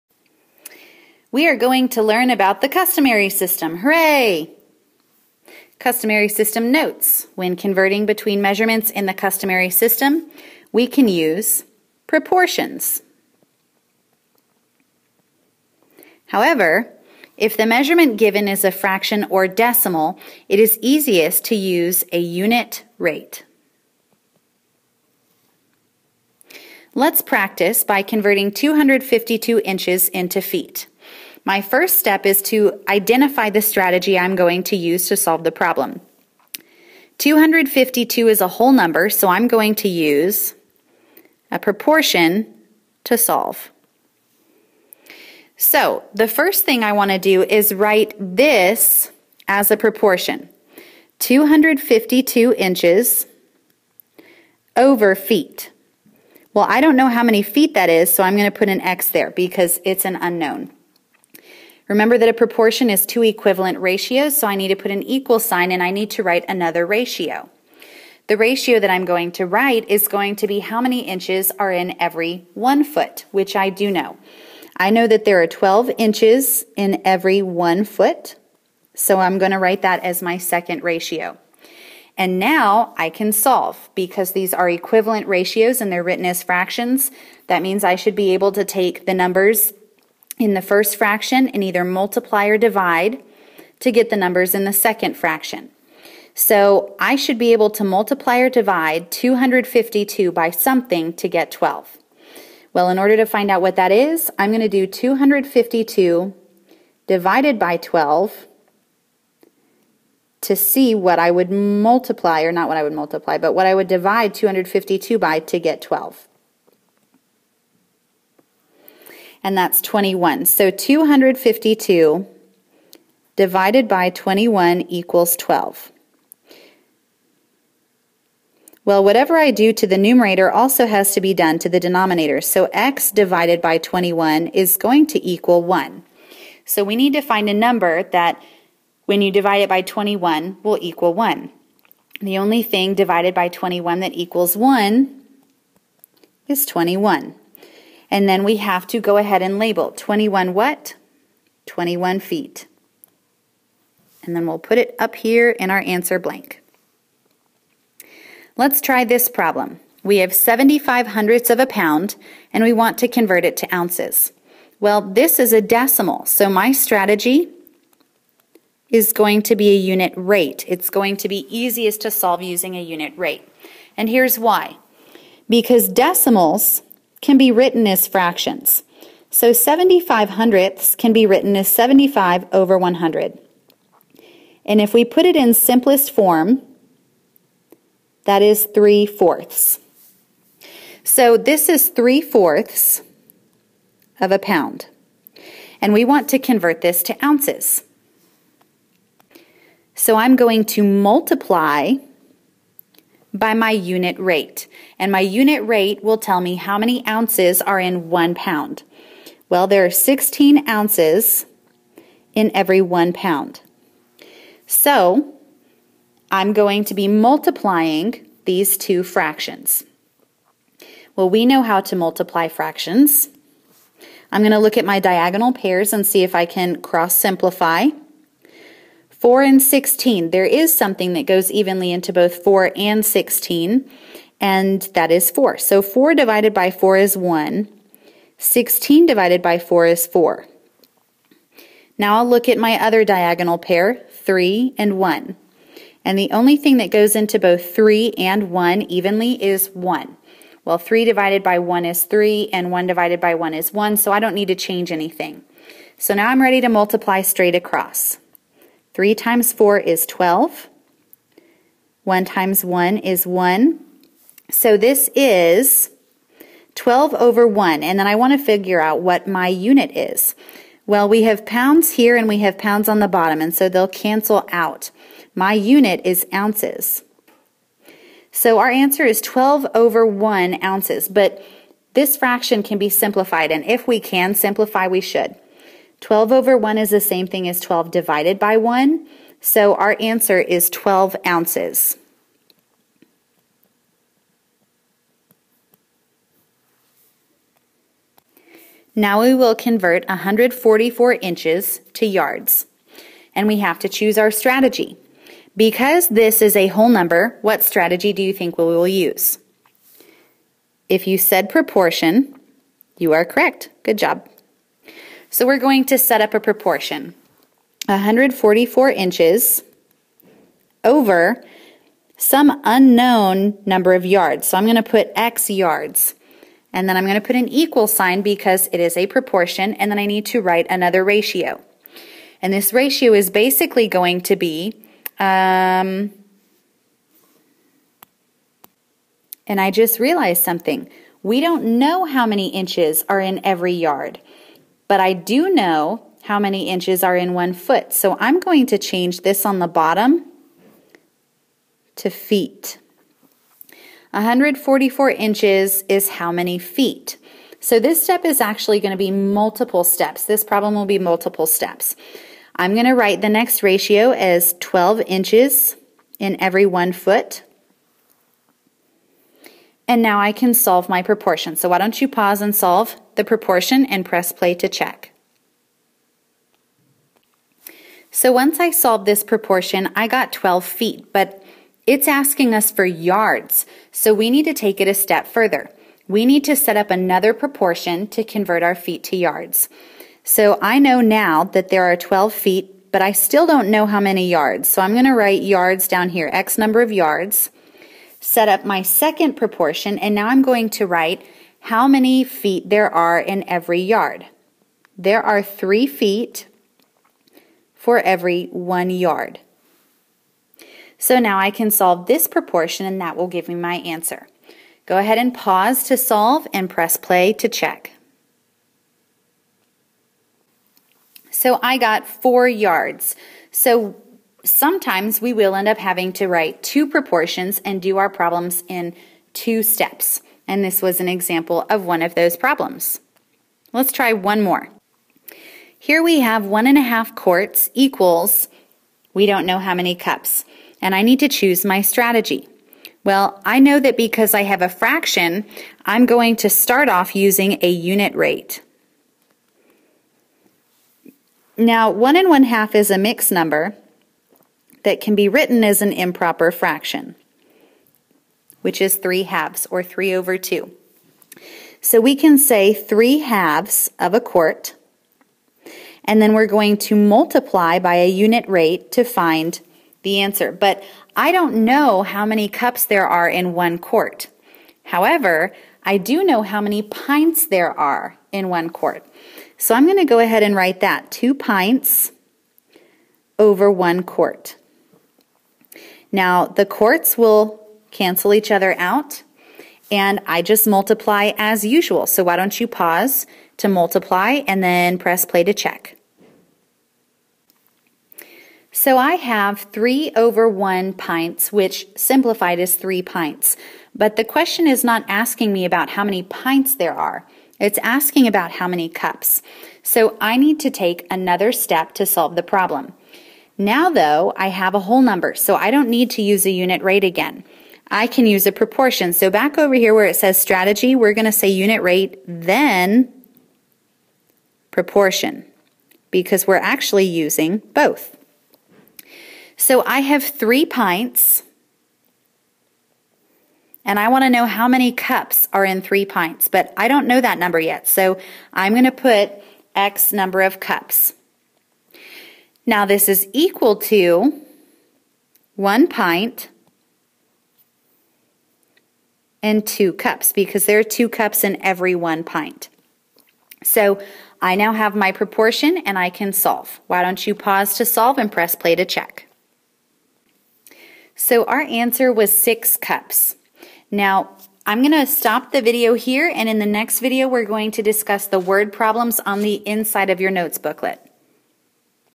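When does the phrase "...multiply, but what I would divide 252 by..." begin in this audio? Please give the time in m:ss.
1:52.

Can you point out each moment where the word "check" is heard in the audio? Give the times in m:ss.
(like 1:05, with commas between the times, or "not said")
6:14, 6:57, 8:15, 9:18.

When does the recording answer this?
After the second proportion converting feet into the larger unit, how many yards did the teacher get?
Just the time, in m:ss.
7:02.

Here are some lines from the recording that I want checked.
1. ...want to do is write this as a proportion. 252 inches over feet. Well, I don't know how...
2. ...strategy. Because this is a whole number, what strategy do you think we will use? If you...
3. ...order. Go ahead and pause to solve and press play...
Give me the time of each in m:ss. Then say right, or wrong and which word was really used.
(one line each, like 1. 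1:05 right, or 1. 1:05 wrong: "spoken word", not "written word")
1. 0:46 right
2. 5:04 right
3. 6:53 wrong: "answer", not "order".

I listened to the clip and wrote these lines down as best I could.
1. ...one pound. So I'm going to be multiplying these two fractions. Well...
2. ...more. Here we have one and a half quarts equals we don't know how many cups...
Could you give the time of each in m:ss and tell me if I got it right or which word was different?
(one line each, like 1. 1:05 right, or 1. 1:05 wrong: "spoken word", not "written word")
1. 3:32 right
2. 7:14 right.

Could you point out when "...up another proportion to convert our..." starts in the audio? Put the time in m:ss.
6:26.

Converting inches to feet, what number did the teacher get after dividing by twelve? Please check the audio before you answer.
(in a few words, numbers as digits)
21.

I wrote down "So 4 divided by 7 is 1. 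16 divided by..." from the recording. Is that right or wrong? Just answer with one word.
wrong.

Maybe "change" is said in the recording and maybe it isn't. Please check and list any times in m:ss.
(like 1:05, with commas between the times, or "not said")
4:14, 5:48.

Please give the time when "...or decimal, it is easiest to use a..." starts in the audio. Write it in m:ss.
0:19.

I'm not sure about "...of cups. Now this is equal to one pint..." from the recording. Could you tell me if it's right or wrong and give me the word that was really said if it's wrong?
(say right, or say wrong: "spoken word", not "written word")
right.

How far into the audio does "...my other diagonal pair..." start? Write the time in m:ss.
4:02.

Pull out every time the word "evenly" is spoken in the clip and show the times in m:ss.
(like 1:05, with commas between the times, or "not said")
3:51, 4:08.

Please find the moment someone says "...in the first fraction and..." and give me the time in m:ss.
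1:30.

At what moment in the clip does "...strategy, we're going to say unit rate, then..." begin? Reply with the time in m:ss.
8:40.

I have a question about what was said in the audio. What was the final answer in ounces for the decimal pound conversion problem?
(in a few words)
12 ounces.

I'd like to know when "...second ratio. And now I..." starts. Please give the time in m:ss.
1:20.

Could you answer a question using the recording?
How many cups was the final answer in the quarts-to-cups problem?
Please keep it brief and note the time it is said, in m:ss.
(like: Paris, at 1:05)
6, at 9:22.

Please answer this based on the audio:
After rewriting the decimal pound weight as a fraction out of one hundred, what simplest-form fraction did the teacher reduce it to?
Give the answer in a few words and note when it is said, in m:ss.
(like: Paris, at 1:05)
3/4, at 3:08.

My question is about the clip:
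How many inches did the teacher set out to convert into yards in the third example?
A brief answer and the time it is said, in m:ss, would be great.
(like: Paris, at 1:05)
144, at 5:00.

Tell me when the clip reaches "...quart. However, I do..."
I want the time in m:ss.
7:53.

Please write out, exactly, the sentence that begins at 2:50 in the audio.
It's going to be easiest to solve using a unit rate.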